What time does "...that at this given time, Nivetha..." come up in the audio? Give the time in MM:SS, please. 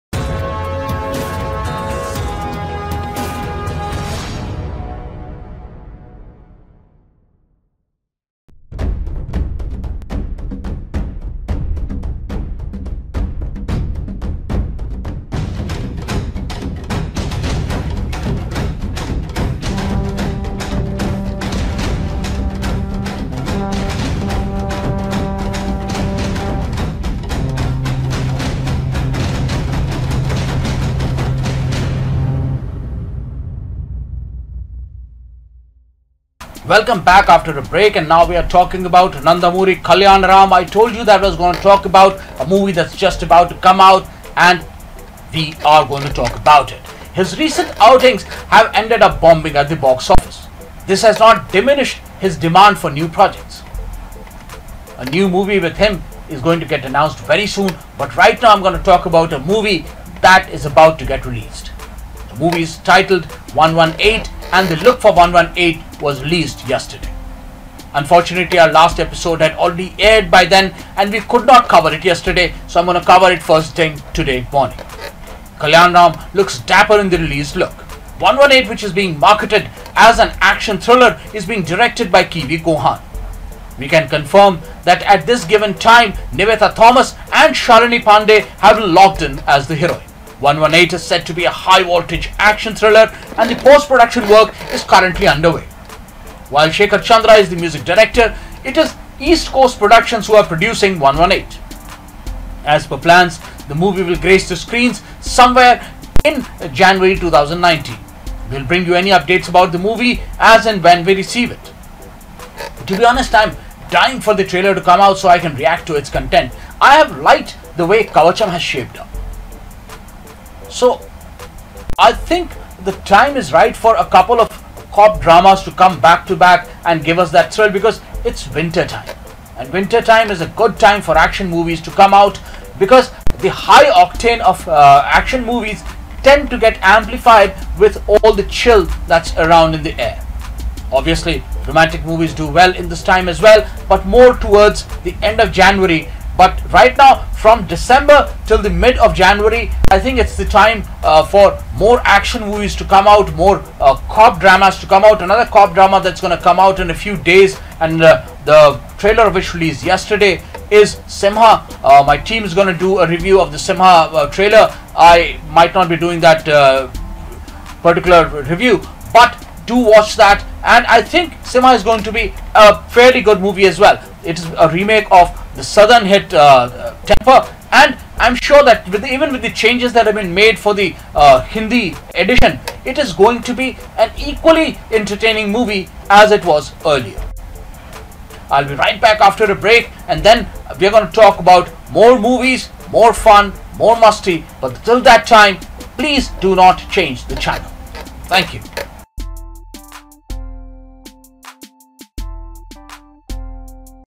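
01:24.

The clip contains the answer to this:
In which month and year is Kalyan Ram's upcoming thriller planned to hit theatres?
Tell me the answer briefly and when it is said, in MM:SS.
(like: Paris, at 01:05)
January 2019, at 01:46.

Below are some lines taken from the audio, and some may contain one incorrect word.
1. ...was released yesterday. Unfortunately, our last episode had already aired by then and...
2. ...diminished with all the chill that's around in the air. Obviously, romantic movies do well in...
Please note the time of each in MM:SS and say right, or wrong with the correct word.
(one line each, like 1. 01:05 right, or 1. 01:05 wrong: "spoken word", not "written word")
1. 01:06 right
2. 02:16 wrong: "amplified", not "diminished".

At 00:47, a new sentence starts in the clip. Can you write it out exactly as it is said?
His recent outings have ended up bombing at the box office.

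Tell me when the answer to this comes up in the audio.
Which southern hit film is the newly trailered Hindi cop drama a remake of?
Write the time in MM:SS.
02:57.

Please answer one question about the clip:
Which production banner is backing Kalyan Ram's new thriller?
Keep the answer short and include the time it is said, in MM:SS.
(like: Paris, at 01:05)
East Coast Productions, at 01:39.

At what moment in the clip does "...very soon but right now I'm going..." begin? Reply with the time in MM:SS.
00:57.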